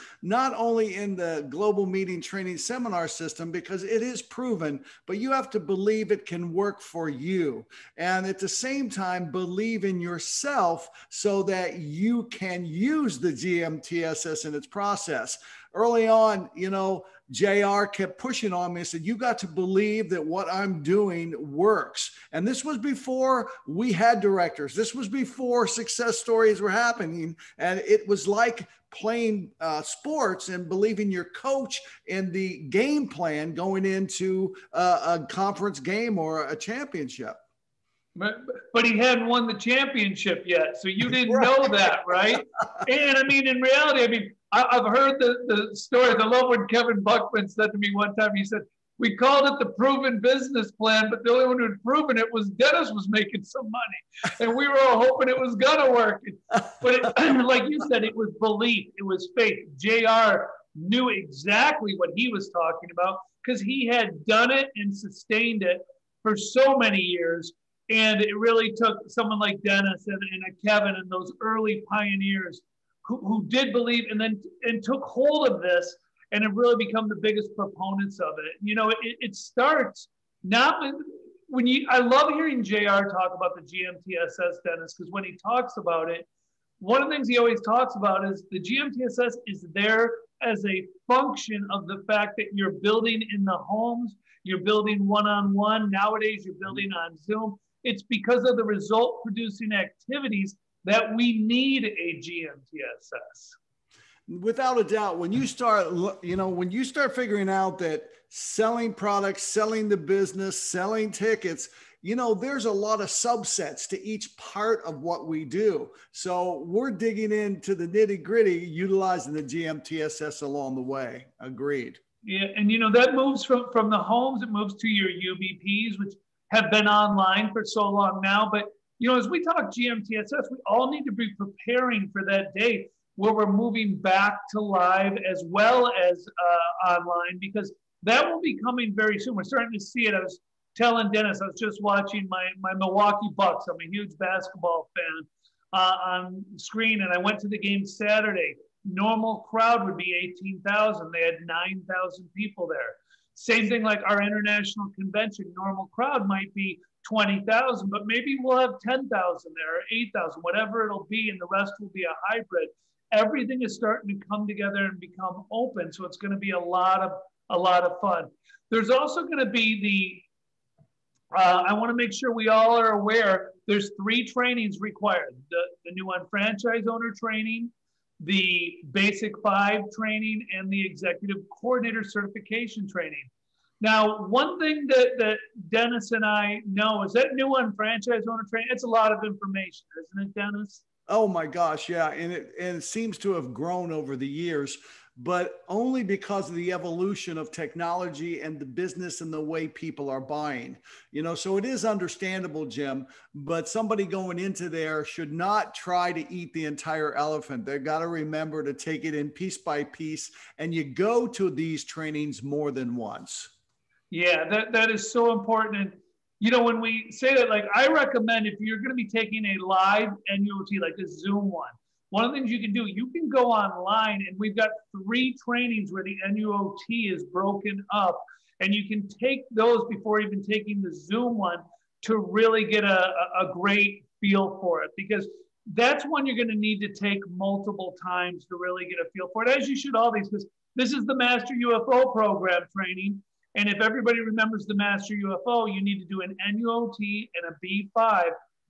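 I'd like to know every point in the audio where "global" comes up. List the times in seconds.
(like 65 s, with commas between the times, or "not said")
1 s.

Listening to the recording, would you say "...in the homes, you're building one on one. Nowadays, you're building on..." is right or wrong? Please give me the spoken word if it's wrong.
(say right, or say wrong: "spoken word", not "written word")
right.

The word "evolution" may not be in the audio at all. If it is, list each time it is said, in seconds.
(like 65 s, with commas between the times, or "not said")
196 s.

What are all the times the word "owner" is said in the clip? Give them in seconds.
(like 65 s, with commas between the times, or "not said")
176 s, 188 s.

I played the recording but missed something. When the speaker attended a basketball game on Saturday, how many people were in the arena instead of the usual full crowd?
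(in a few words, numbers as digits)
9,000.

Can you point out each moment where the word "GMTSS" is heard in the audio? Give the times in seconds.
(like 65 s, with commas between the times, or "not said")
13 s, 83 s, 88 s, 102 s, 119 s, 129 s.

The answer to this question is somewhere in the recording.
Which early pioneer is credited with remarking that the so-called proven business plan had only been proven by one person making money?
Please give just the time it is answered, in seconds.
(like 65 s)
46 s.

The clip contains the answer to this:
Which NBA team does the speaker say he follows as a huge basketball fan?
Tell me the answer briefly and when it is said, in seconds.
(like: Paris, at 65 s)
Milwaukee Bucks, at 142 s.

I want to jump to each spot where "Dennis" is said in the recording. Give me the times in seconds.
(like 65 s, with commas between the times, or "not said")
52 s, 69 s, 84 s, 141 s, 185 s, 190 s.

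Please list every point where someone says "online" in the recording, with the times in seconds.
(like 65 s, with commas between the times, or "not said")
126 s, 136 s, 223 s.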